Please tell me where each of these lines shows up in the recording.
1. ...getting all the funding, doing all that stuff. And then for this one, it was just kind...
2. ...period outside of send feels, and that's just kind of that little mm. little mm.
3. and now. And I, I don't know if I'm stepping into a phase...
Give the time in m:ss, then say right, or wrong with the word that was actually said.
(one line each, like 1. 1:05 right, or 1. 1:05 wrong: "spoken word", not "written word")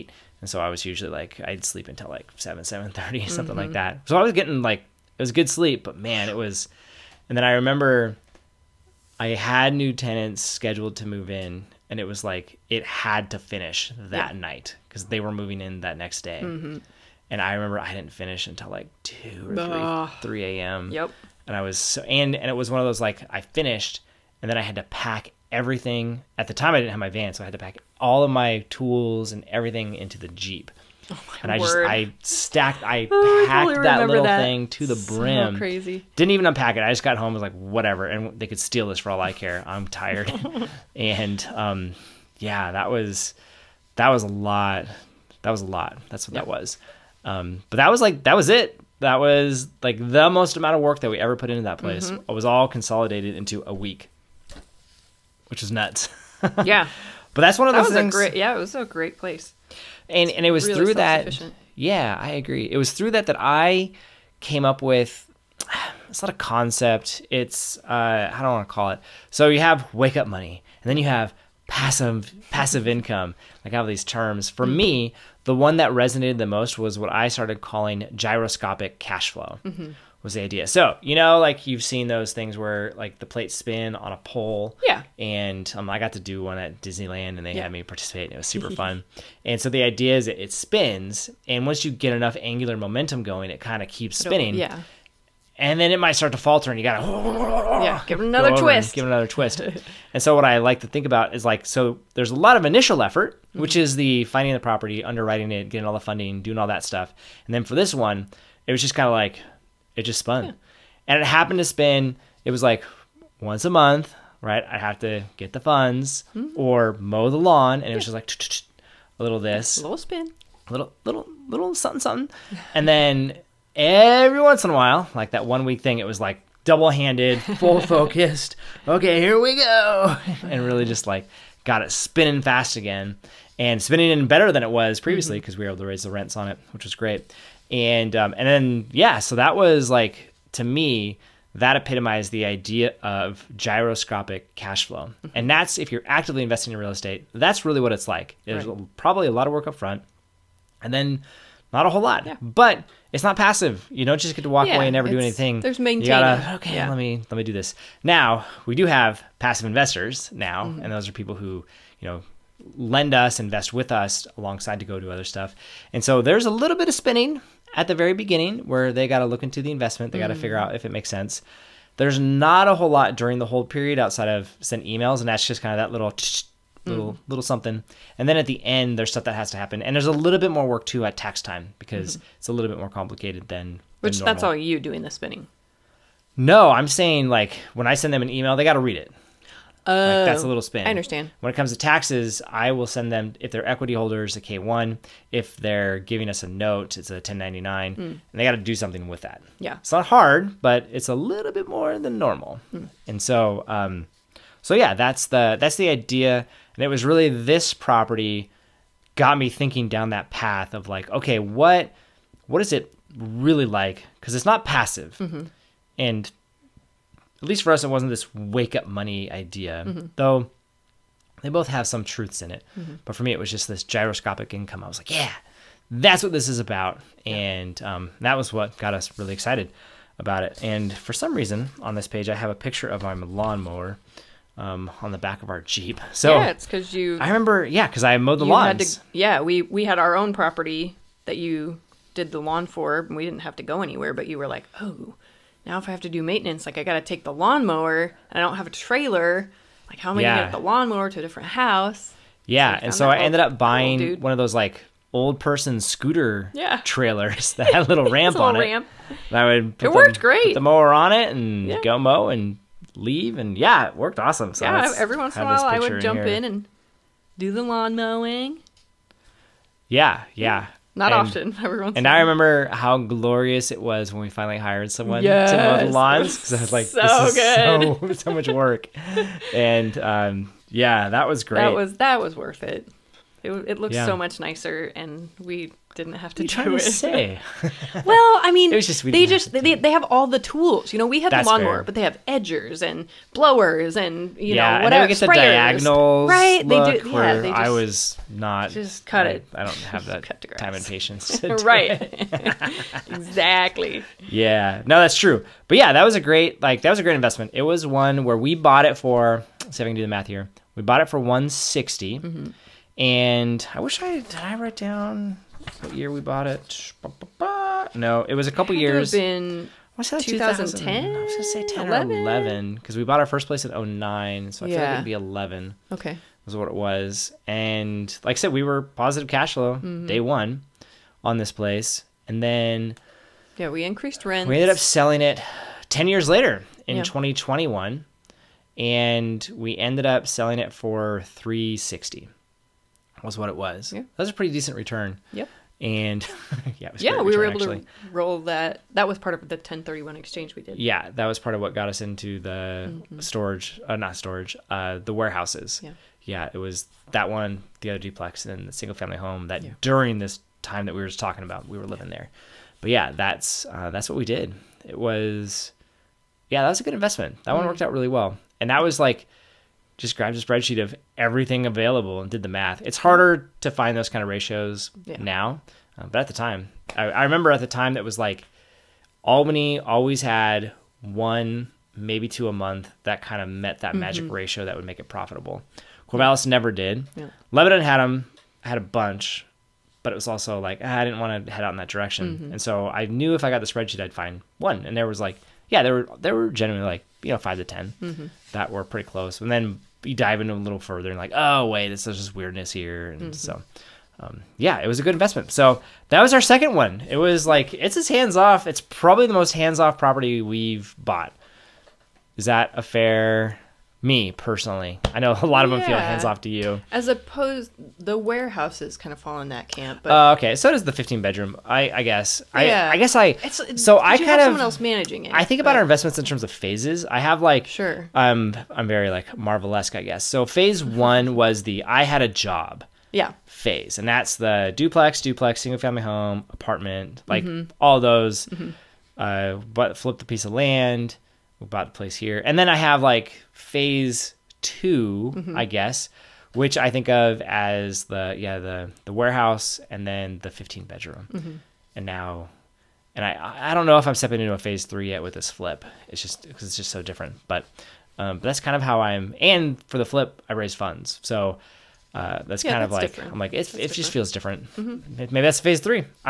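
1. 1:45 right
2. 2:53 wrong: "emails", not "feels"
3. 7:31 right.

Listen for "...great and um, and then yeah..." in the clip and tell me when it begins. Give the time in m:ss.
2:16.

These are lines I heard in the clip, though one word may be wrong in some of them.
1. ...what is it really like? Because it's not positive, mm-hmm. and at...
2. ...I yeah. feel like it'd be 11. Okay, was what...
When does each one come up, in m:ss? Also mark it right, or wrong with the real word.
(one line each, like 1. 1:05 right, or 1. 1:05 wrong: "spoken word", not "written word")
1. 3:32 wrong: "passive", not "positive"
2. 5:24 right.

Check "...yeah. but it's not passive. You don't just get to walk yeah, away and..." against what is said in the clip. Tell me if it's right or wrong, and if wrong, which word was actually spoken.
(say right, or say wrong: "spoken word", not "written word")
right.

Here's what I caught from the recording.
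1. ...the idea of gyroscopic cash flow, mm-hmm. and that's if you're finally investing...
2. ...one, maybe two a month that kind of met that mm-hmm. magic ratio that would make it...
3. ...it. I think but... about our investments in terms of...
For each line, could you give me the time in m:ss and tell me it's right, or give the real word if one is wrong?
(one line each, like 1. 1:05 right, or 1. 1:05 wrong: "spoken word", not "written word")
1. 2:22 wrong: "actively", not "finally"
2. 6:21 right
3. 7:05 right.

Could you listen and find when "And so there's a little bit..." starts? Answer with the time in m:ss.
2:45.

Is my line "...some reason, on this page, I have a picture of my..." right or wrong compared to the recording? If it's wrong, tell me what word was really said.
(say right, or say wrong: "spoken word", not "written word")
right.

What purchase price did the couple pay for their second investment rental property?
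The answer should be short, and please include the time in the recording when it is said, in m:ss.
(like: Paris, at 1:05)
160, at 5:11.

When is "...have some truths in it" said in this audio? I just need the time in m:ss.
3:41.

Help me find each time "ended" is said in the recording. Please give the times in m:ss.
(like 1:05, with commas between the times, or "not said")
4:13, 5:34, 5:39.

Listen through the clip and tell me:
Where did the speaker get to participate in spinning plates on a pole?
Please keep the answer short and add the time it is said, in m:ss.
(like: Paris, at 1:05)
Disneyland, at 1:26.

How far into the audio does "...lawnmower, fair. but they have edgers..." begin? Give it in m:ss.
4:51.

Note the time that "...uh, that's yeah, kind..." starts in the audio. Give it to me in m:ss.
7:42.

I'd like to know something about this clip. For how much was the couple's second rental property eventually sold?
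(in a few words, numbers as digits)
360.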